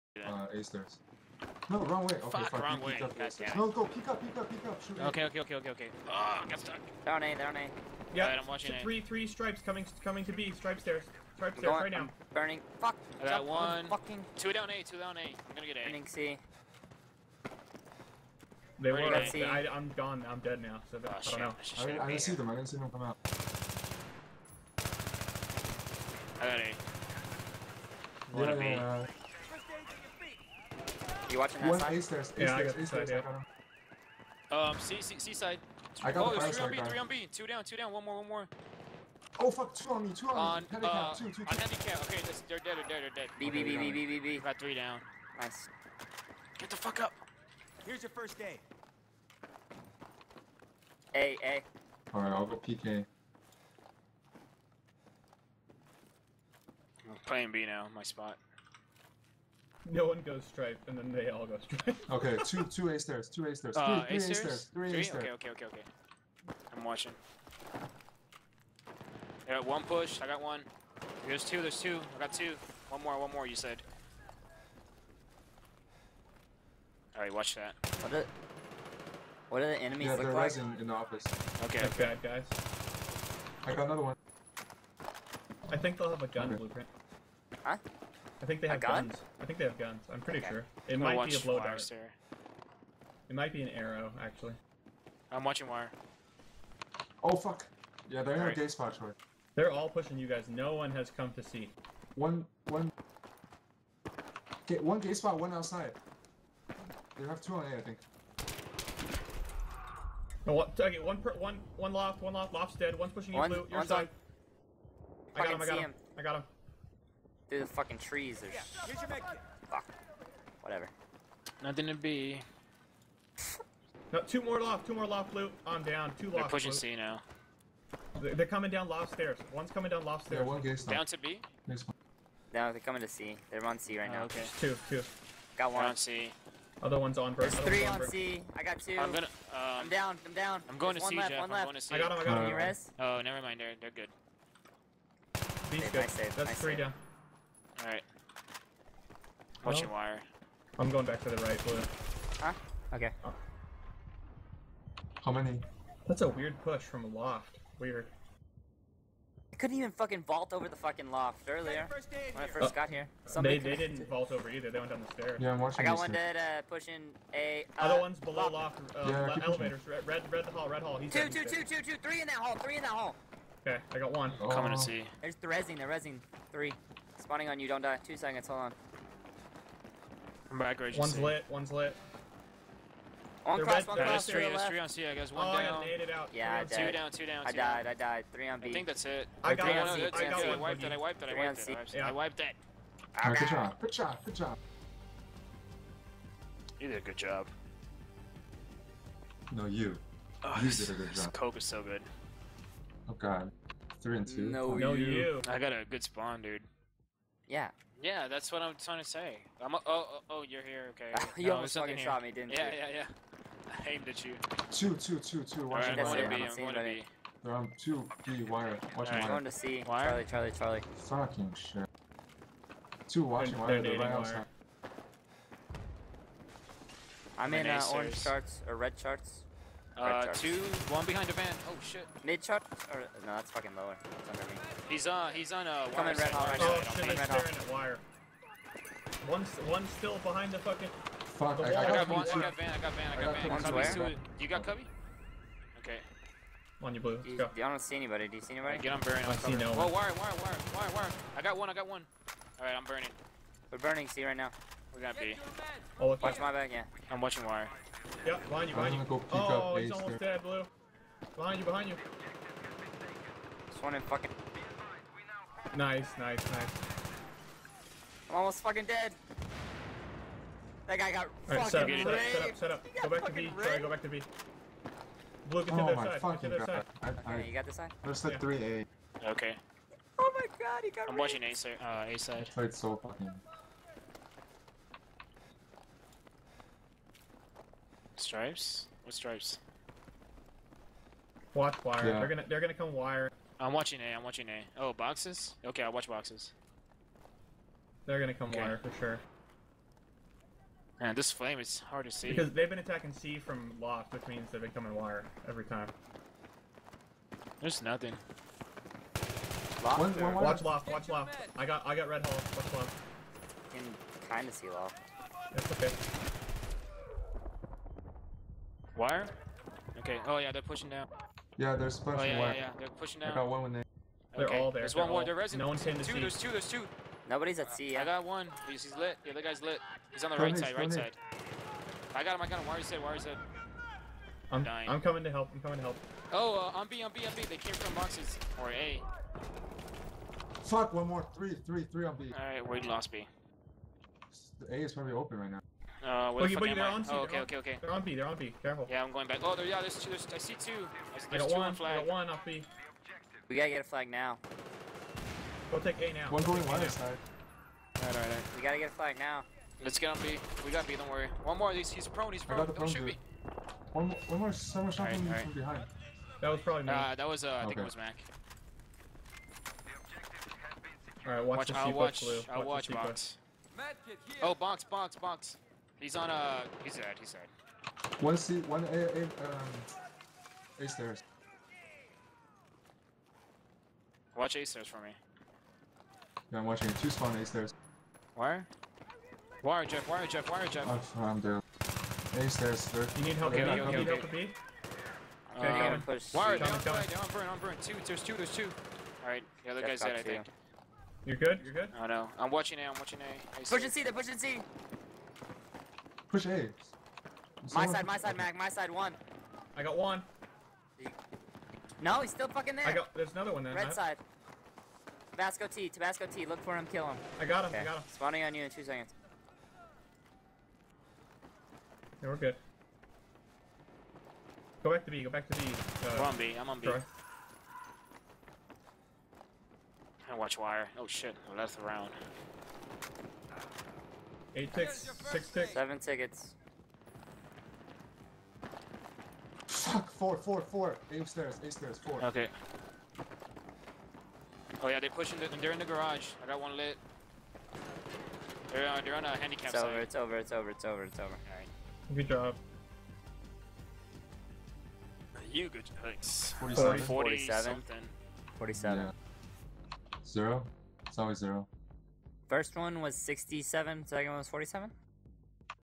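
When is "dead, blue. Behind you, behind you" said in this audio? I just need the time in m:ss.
4:20.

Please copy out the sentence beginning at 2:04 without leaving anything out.
No, two more loft, two more loft loot on down, two loft.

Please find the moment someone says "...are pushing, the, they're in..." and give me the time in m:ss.
7:25.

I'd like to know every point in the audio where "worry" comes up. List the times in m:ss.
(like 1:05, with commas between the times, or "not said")
6:01.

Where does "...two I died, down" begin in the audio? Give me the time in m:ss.
3:07.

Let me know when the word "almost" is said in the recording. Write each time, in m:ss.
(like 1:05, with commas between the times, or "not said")
3:31, 4:19, 4:28.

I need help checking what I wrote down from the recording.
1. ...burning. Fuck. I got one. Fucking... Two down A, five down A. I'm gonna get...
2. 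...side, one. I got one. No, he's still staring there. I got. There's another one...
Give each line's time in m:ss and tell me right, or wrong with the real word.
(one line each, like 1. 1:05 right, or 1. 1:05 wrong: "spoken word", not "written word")
1. 0:12 wrong: "two", not "five"
2. 6:48 wrong: "fucking", not "staring".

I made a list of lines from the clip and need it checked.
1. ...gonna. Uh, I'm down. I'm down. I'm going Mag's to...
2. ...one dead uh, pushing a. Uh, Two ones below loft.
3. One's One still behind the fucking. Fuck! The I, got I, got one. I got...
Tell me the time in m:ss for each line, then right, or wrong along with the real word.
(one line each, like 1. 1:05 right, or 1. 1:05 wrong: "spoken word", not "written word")
1. 2:19 wrong: "There", not "Mag"
2. 2:45 wrong: "Other", not "Two"
3. 3:59 right.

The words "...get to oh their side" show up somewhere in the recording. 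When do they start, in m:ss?
4:35.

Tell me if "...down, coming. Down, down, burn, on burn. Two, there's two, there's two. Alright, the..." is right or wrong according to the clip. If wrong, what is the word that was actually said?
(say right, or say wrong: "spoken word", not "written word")
right.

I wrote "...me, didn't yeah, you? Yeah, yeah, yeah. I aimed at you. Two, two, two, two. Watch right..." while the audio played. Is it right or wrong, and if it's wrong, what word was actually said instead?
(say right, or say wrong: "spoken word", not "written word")
right.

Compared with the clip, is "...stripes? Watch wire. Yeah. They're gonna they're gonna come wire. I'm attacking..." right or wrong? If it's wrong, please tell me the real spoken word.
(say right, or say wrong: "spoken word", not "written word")
wrong: "watching", not "attacking".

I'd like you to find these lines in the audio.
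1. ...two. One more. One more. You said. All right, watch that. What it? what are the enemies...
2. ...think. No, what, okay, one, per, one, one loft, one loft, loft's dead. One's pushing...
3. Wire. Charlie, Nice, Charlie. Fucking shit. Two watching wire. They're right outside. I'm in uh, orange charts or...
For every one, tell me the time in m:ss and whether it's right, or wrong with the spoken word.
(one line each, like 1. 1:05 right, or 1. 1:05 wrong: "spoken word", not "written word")
1. 1:12 right
2. 1:47 right
3. 3:39 wrong: "Charlie", not "Nice".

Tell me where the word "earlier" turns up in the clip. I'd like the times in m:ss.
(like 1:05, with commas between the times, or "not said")
2:41.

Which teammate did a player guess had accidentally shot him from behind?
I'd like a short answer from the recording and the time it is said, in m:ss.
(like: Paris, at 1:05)
Mac, at 6:07.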